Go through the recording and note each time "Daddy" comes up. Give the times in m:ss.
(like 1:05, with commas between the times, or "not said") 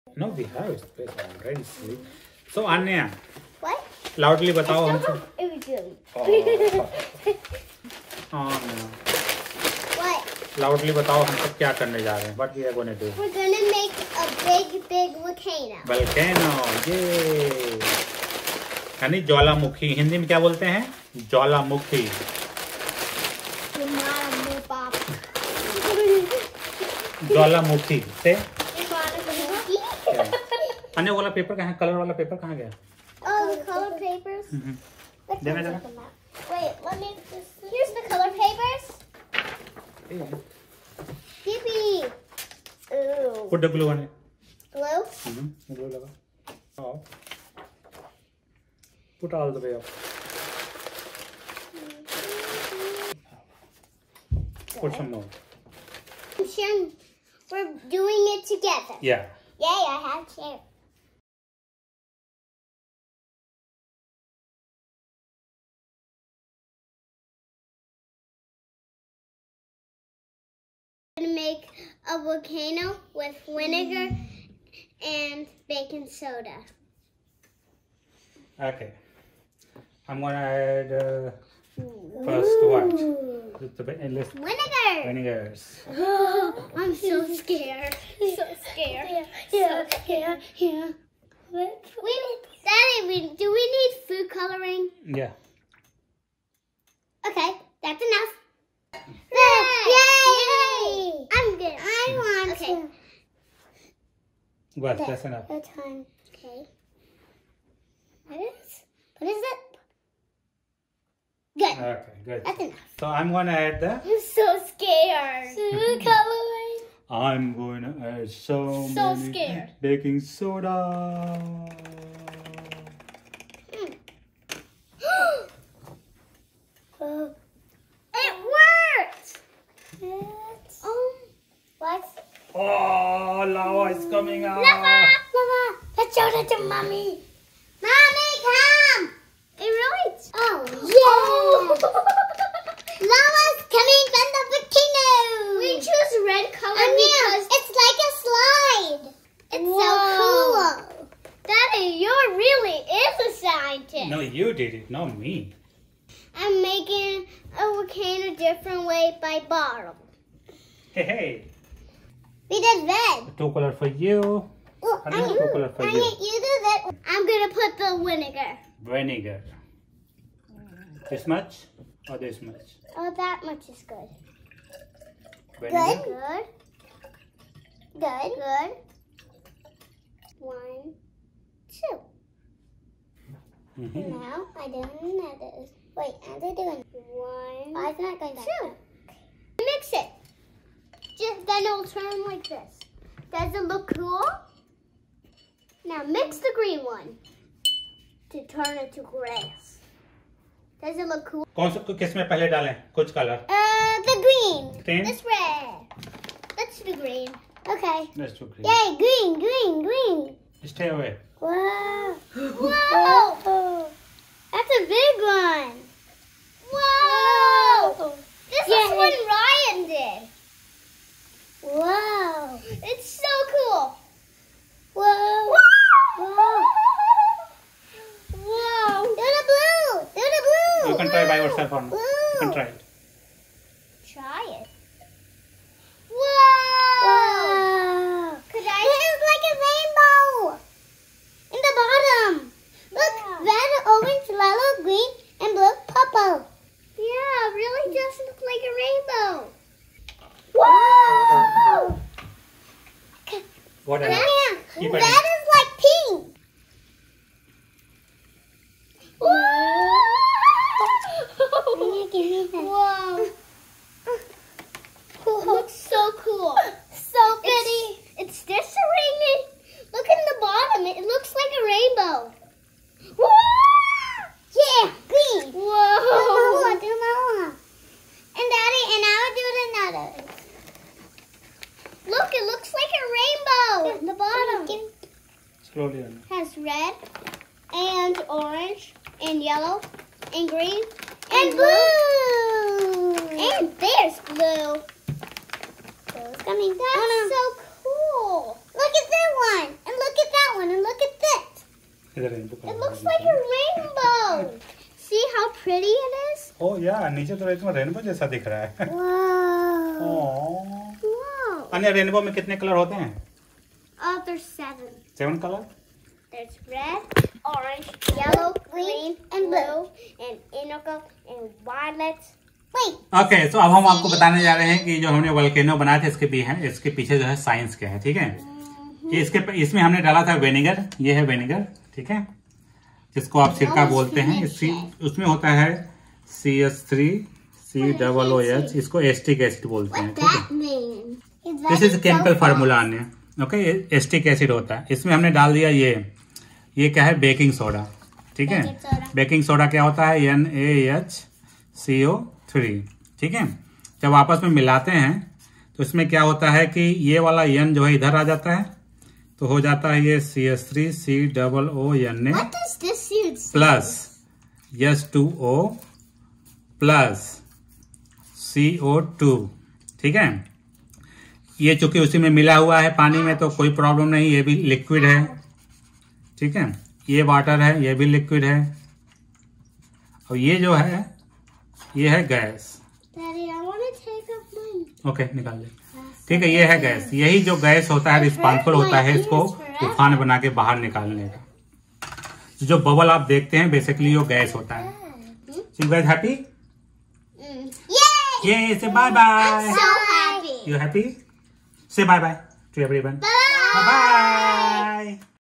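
1:32, 2:31.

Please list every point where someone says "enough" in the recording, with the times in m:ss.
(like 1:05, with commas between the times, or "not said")
1:38, 1:45, 1:52.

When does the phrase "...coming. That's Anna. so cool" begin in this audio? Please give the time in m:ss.
4:56.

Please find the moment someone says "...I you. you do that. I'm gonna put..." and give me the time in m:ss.
2:45.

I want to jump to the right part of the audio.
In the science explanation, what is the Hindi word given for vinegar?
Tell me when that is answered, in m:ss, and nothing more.
5:33.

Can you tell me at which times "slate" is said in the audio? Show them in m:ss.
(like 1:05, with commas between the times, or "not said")
not said.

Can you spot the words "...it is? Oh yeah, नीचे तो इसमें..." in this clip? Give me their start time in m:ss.
5:05.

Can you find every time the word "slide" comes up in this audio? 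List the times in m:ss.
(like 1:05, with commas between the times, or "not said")
2:29.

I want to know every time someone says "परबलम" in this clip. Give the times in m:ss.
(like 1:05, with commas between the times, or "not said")
6:13.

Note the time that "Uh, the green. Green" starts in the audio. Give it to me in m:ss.
3:23.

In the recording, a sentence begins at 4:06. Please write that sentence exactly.
Yeah, really does look like a rainbow.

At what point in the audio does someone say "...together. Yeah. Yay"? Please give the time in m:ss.
0:58.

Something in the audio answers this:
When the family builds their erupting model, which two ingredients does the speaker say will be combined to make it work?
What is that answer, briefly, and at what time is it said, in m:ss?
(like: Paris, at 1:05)
vinegar and baking soda, at 1:13.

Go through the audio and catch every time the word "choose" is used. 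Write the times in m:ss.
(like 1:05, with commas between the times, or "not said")
2:25.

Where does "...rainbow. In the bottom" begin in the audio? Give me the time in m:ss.
3:59.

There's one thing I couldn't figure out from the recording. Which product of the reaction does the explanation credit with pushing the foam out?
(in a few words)
CO2 gas.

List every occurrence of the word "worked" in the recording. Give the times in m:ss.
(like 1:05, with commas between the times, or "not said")
2:08.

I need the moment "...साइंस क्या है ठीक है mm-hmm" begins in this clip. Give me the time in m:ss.
5:27.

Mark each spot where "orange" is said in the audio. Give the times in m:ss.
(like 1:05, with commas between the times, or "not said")
4:03, 4:48, 5:17.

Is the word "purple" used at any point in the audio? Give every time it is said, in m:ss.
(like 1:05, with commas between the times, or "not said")
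4:05.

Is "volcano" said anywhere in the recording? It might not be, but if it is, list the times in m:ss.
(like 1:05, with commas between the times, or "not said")
1:12, 2:24, 2:37.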